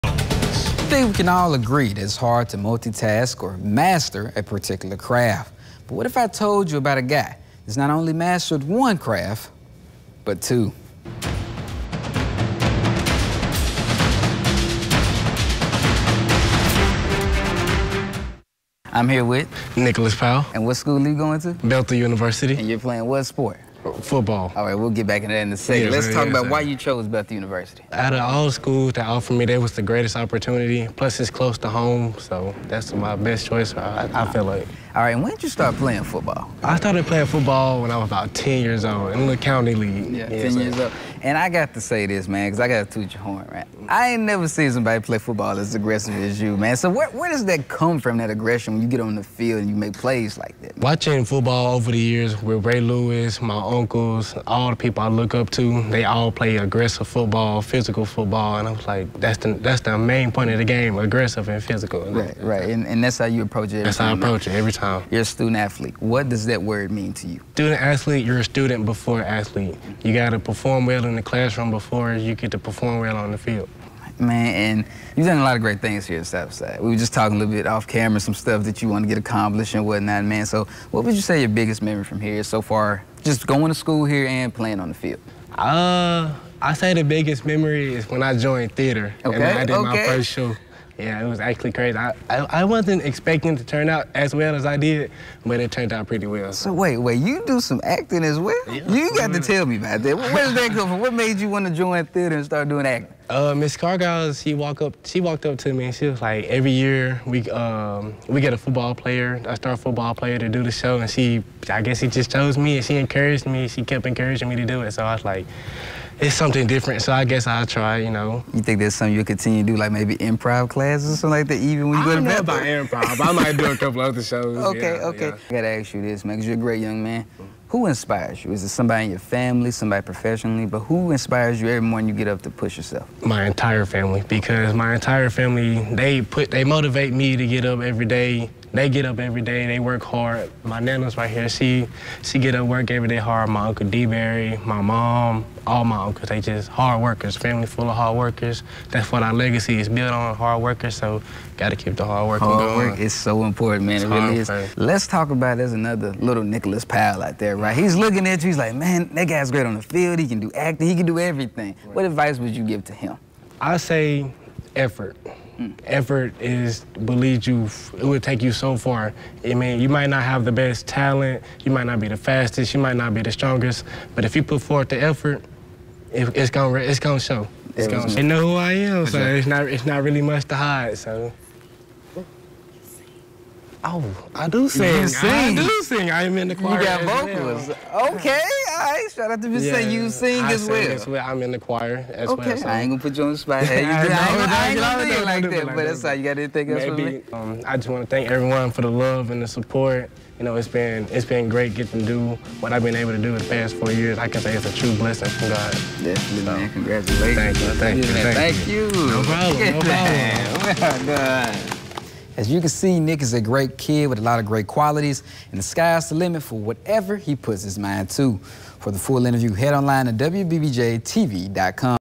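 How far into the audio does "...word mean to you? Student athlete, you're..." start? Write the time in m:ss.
1:06.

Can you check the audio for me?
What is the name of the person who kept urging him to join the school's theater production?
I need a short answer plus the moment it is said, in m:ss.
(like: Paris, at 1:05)
Miss Cargill, at 1:43.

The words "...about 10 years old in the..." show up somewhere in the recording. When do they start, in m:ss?
0:38.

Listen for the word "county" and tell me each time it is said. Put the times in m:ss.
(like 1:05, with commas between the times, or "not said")
0:39.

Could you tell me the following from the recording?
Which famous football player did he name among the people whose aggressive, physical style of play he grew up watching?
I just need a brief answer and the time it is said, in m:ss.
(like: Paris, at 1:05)
Ray Lewis, at 0:52.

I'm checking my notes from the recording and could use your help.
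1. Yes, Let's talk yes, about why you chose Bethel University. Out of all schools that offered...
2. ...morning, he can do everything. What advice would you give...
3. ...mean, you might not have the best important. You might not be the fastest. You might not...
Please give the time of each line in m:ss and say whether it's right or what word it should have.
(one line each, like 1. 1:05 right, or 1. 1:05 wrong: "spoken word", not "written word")
1. 0:25 right
2. 2:40 wrong: "acting", not "morning"
3. 2:49 wrong: "talent", not "important".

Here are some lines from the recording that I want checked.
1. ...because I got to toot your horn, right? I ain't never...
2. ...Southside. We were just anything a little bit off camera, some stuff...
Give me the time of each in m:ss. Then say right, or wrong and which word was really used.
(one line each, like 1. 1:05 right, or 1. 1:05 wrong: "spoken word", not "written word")
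1. 0:42 right
2. 1:16 wrong: "talking", not "anything".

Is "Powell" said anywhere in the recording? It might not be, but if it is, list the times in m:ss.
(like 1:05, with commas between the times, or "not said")
0:20, 2:36.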